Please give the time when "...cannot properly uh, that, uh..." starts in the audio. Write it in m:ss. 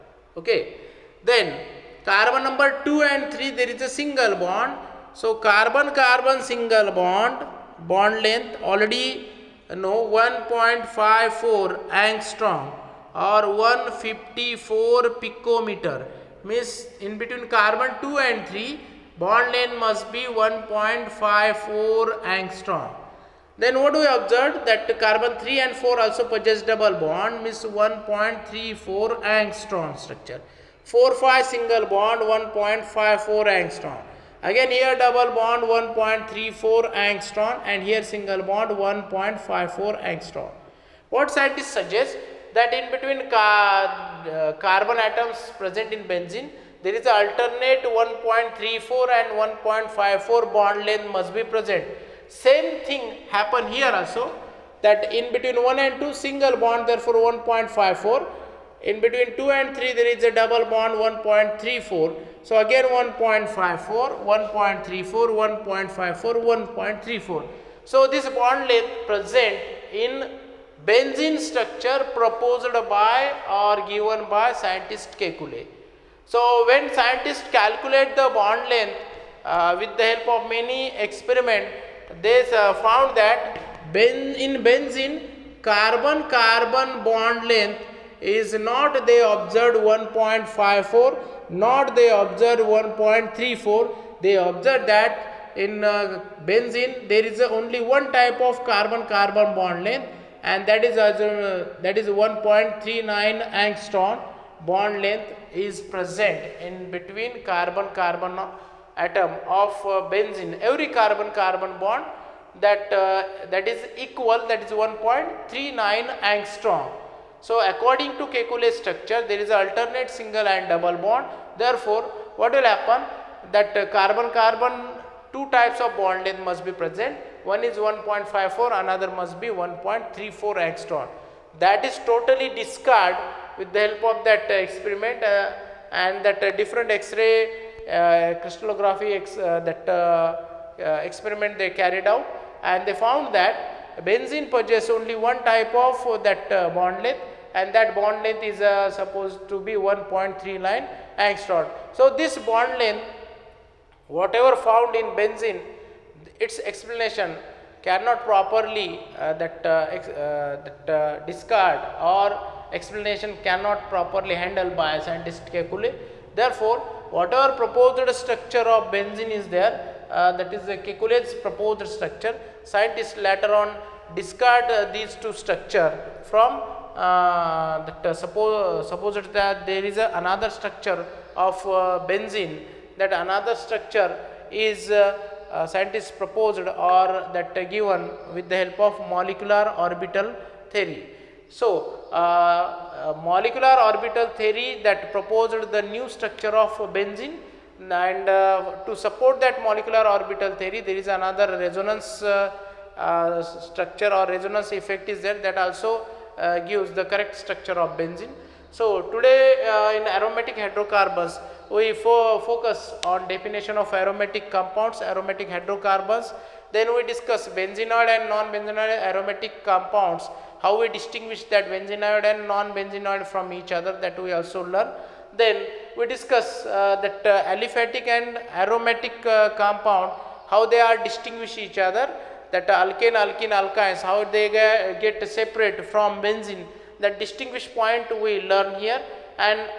2:37.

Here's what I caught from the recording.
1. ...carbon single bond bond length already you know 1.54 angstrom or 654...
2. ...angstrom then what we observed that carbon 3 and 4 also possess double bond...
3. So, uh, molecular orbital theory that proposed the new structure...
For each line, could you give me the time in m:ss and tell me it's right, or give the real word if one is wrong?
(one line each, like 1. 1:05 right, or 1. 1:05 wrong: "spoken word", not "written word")
1. 0:06 wrong: "154", not "654"
2. 0:22 right
3. 3:11 right.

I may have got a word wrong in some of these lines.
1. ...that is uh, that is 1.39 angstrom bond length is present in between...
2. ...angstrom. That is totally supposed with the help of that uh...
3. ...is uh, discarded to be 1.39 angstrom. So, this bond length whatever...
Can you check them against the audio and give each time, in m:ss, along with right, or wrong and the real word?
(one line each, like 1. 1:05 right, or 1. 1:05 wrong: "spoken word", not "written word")
1. 1:40 right
2. 2:10 wrong: "discarded", not "supposed"
3. 2:28 wrong: "supposed", not "discarded".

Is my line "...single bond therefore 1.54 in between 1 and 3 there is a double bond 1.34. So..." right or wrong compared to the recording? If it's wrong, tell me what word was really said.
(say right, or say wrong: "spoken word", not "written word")
wrong: "2", not "1".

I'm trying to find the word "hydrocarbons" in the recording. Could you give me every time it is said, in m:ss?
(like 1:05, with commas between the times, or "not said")
3:30, 3:35.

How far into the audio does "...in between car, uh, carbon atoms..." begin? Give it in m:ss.
0:42.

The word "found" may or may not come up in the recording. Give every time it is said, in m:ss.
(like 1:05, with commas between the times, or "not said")
1:22, 2:22, 2:34.